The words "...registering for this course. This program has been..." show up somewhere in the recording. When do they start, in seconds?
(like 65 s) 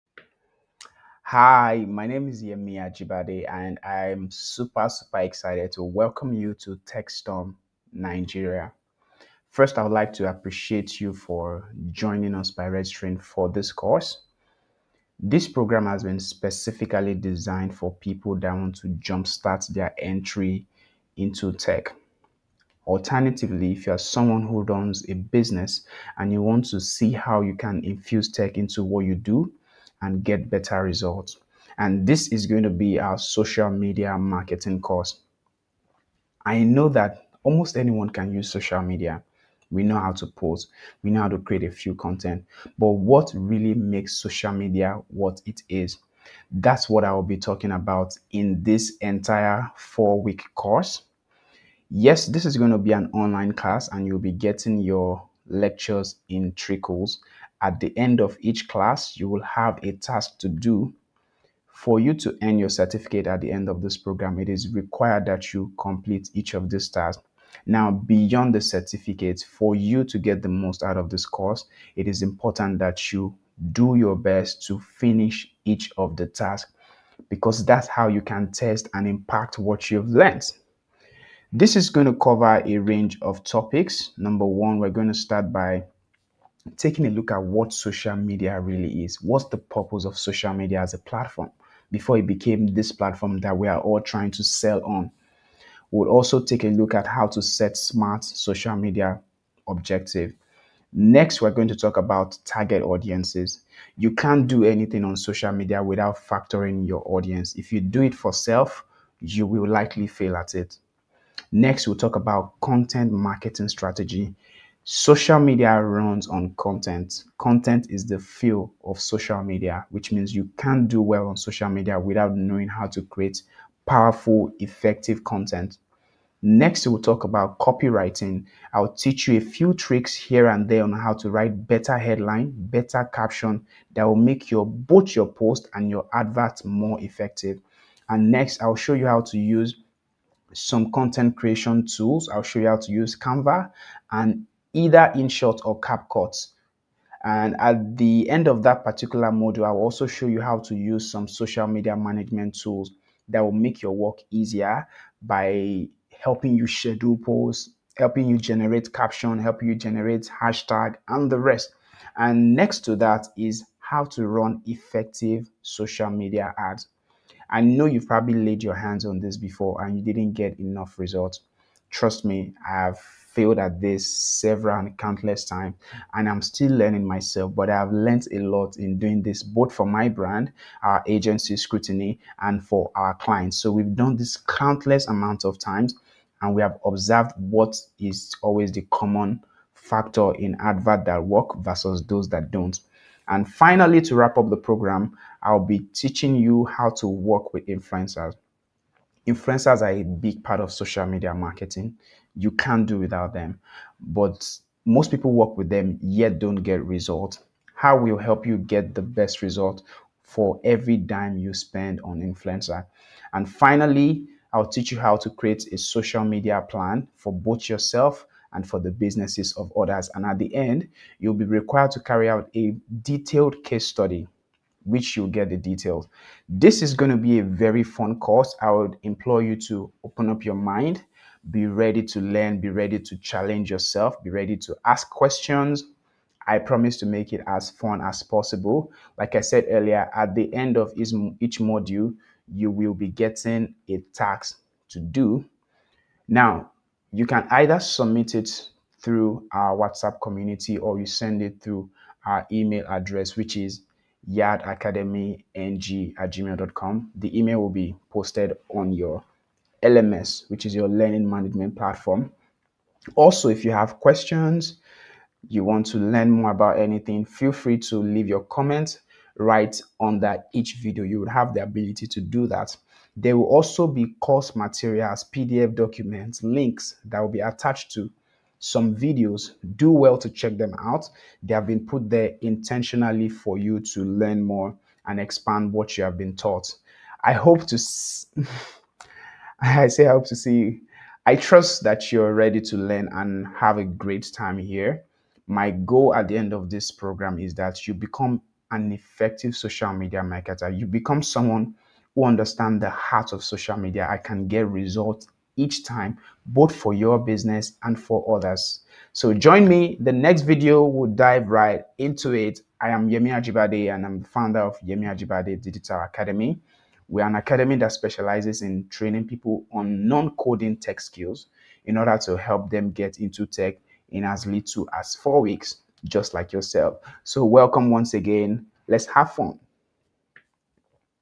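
12 s.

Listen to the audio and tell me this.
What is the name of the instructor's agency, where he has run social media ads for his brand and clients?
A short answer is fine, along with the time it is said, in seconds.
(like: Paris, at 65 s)
Scrutiny, at 181 s.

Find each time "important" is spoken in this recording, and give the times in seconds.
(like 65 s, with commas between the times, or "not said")
72 s.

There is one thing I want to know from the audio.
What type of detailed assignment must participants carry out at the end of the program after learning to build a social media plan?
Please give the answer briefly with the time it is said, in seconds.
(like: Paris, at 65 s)
Case study, at 223 s.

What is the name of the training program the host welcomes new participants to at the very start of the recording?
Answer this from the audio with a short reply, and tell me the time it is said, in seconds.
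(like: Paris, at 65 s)
TechStorm Nigeria, at 6 s.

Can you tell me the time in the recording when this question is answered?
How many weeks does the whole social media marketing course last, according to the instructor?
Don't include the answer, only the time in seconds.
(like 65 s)
49 s.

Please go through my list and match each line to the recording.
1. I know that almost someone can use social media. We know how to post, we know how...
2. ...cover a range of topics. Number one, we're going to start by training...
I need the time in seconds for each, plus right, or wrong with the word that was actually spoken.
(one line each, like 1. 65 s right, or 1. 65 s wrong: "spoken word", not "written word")
1. 36 s wrong: "anyone", not "someone"
2. 82 s wrong: "taking", not "training".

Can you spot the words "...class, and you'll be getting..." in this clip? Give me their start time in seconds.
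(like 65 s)
53 s.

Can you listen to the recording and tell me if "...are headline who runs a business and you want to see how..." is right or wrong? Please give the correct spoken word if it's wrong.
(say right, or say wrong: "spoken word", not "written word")
wrong: "someone", not "headline".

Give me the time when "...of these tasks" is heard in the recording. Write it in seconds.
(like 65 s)
66 s.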